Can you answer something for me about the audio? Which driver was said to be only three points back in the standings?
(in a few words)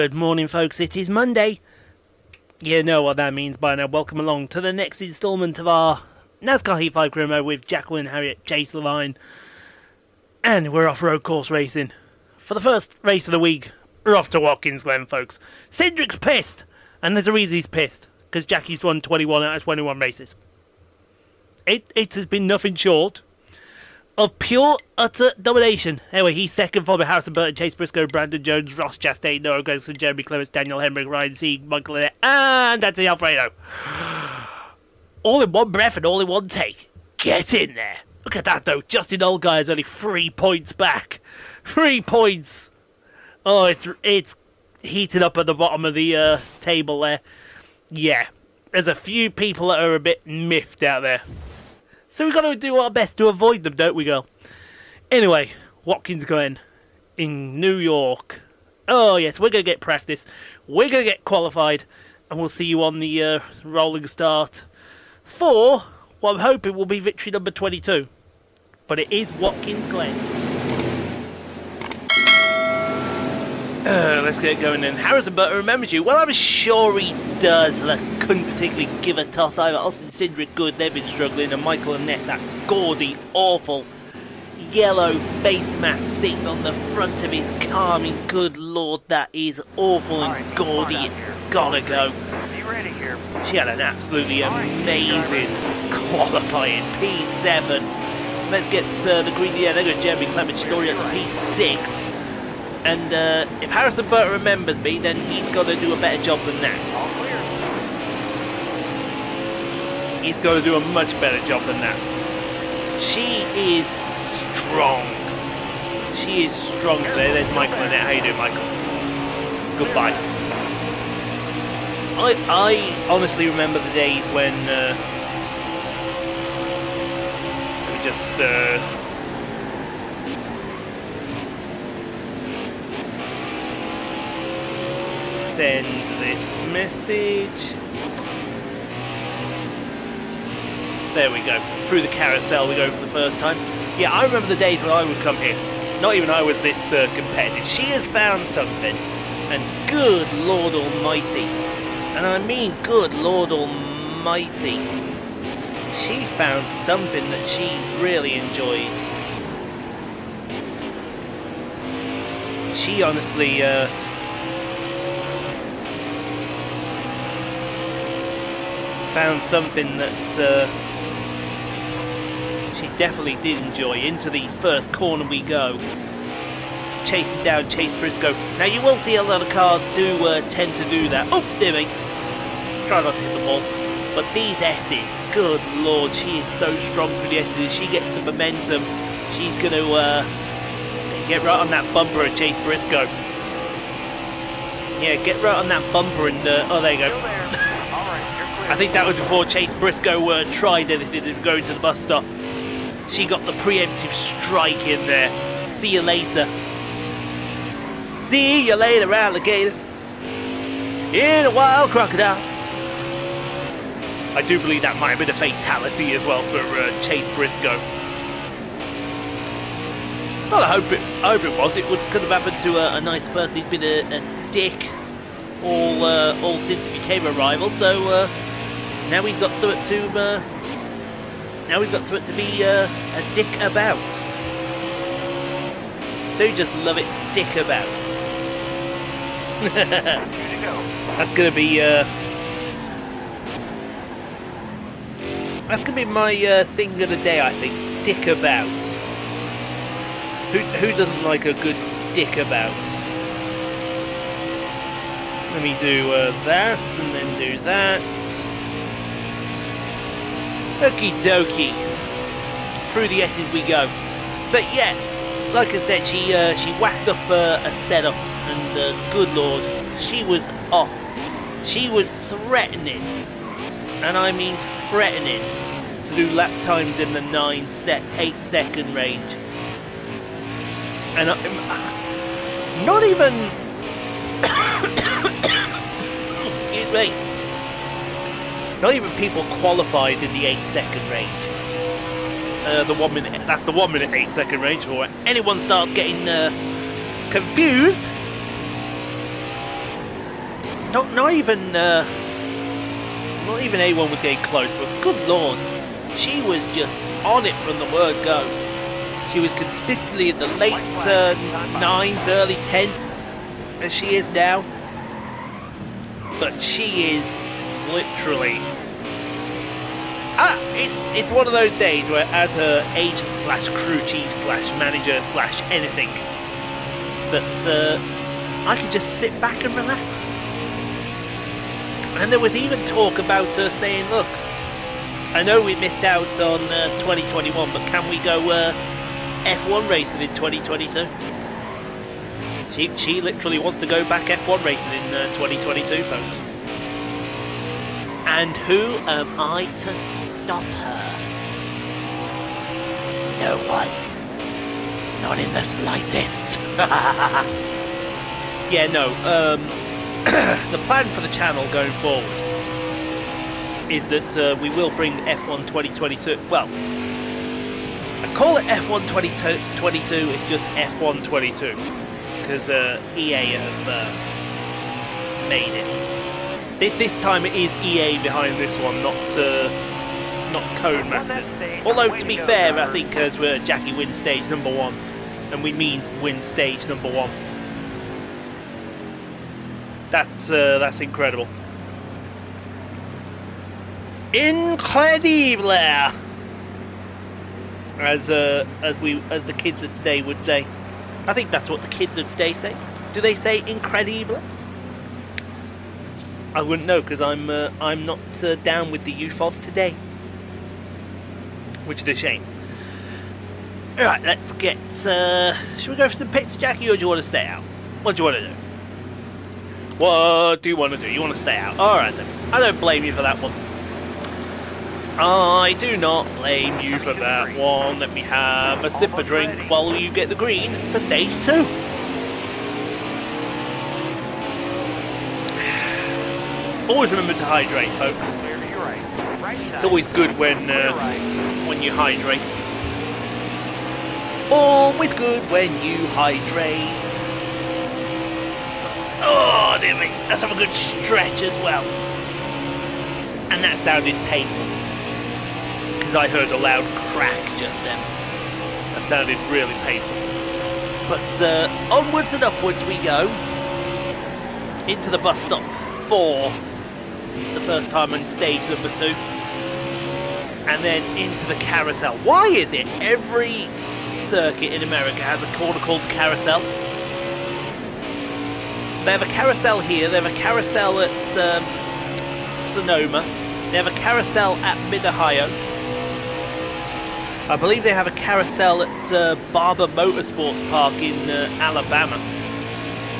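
Justin Allgaier.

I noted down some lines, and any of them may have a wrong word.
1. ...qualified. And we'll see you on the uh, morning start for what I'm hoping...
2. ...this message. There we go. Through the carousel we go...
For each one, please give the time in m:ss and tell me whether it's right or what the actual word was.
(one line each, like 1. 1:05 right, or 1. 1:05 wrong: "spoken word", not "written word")
1. 1:01 wrong: "rolling", not "morning"
2. 2:16 right.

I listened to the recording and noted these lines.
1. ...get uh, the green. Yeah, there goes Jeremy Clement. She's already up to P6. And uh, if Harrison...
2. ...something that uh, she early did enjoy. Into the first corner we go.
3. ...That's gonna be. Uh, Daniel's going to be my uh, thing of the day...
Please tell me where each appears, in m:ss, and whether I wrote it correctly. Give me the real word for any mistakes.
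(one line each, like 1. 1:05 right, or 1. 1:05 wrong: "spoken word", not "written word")
1. 1:38 right
2. 2:49 wrong: "definitely", not "early"
3. 4:01 wrong: "That", not "Daniel".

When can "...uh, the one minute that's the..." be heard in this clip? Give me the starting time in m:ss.
4:52.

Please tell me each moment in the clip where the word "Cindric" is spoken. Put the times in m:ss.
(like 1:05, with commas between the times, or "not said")
0:15, 1:20.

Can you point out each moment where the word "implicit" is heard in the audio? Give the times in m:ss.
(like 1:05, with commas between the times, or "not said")
not said.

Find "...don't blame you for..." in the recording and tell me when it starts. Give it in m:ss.
7:02.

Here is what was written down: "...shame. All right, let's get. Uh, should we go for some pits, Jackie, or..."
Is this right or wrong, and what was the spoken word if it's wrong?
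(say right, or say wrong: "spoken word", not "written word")
right.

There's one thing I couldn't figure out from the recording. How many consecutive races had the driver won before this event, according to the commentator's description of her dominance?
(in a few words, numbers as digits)
21.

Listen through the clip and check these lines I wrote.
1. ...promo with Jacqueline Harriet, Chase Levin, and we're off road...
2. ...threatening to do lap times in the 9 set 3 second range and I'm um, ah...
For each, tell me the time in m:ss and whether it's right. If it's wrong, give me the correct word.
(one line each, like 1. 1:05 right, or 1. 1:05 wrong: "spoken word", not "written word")
1. 0:07 right
2. 4:34 wrong: "8", not "3".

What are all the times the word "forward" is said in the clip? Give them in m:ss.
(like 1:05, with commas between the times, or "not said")
6:02.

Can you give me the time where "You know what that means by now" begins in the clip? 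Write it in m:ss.
0:02.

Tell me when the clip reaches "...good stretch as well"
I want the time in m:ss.
7:30.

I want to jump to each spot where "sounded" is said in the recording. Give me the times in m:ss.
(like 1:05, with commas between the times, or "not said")
7:33, 7:39.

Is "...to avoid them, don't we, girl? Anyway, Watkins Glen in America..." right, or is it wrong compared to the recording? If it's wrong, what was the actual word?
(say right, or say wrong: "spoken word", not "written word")
wrong: "New", not "America".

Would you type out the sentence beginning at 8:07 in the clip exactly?
I believe they have a carousel at uh, Barber Motorsports Park in uh, Alabama.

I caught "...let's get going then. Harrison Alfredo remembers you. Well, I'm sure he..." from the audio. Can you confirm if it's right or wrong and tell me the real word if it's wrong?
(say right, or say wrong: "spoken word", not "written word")
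wrong: "Burton", not "Alfredo".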